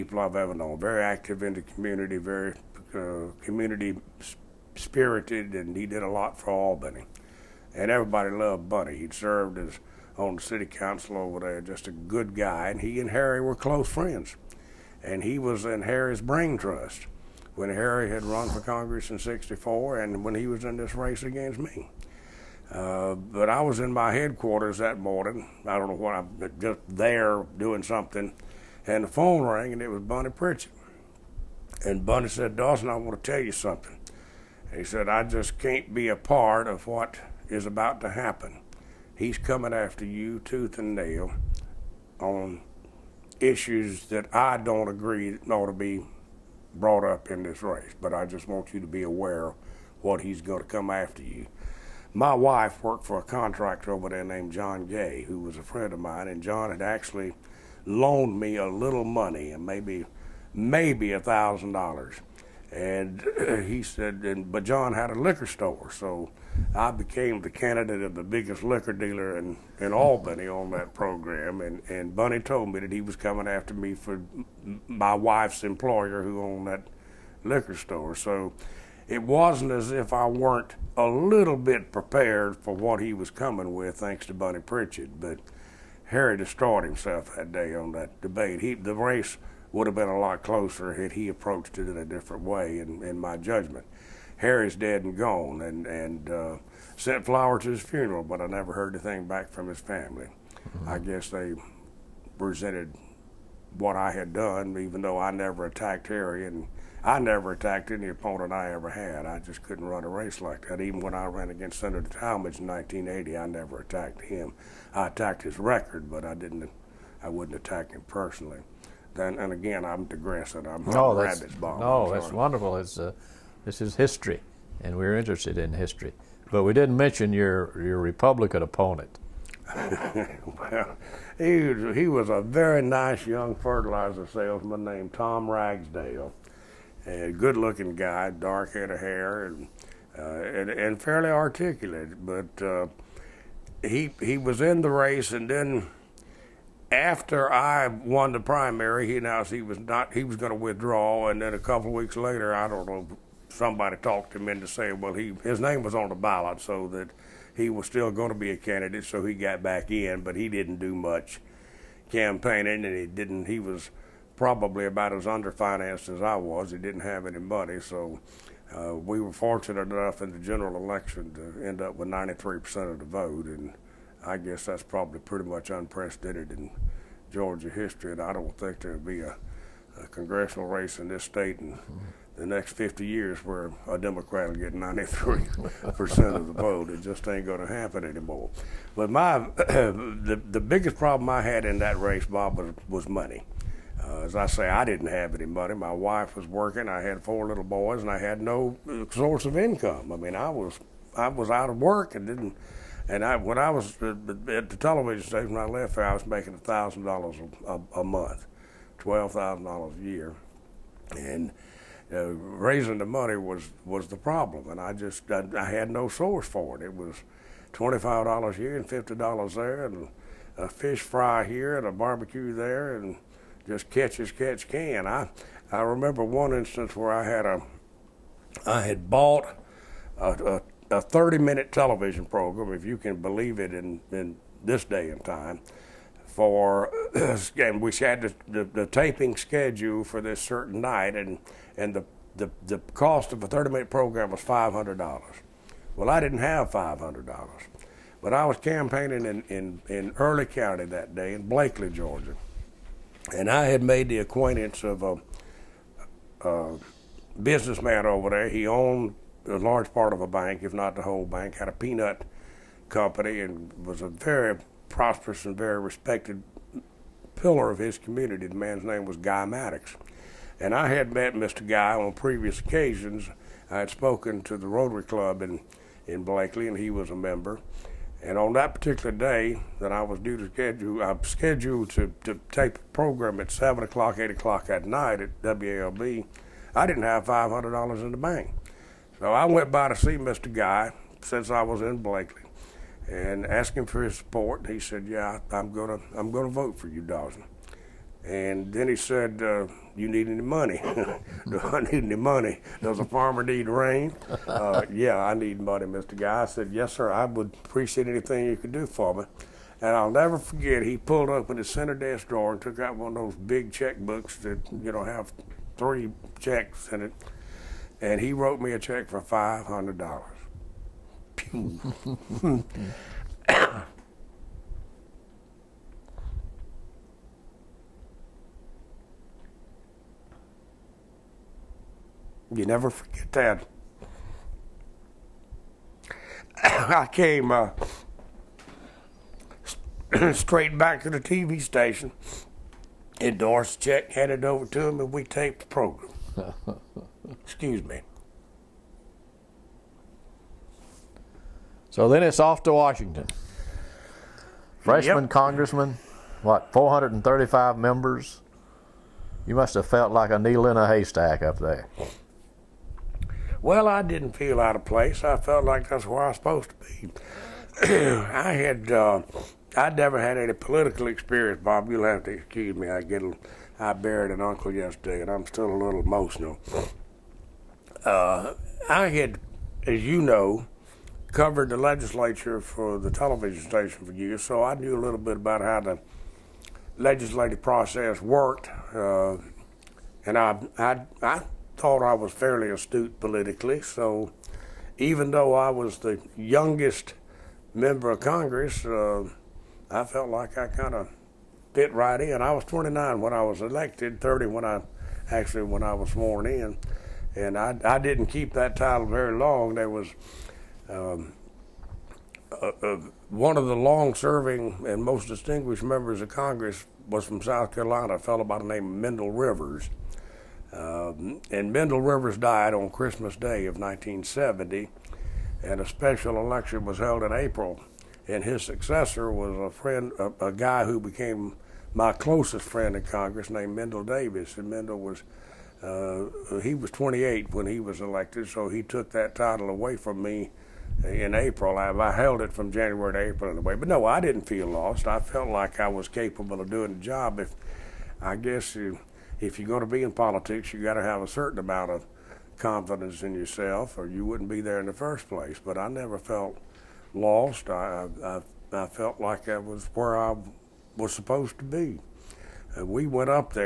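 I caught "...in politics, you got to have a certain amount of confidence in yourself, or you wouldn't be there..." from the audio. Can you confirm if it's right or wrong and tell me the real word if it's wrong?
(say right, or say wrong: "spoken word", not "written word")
right.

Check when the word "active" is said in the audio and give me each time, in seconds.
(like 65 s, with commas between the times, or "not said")
1 s.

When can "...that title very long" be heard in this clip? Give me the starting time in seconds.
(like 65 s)
408 s.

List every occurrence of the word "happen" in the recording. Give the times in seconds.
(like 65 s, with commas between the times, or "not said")
38 s, 187 s.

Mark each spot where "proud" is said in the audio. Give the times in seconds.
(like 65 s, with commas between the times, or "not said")
not said.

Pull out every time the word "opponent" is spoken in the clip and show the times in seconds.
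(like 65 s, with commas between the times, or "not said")
108 s, 128 s.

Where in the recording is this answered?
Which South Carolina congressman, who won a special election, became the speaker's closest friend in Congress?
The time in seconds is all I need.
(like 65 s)
433 s.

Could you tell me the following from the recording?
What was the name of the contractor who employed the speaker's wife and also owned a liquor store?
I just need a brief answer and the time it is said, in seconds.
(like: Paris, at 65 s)
John Gay, at 54 s.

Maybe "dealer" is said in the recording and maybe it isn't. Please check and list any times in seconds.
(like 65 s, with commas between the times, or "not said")
68 s.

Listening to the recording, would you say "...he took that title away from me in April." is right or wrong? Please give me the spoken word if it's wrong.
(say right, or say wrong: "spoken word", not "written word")
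right.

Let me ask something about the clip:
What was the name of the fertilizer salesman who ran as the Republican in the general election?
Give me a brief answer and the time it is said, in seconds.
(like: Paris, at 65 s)
Tom Ragsdale, at 135 s.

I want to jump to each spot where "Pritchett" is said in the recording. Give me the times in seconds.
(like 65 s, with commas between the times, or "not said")
30 s, 84 s.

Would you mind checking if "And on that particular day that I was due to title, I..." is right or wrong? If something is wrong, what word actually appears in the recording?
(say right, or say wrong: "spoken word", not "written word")
wrong: "schedule", not "title".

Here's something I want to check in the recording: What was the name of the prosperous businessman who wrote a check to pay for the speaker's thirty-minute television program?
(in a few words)
Guy Maddox.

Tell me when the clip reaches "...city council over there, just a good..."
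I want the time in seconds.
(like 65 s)
10 s.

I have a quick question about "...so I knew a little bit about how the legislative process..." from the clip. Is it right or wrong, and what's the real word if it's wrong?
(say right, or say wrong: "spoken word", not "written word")
right.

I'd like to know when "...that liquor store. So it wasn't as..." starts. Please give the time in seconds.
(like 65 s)
76 s.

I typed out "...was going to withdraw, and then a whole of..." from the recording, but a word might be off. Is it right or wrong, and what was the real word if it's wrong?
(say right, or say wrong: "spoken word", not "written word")
wrong: "couple", not "whole".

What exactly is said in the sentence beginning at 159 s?
So he got back in, but he didn't do much campaigning, and he didn't.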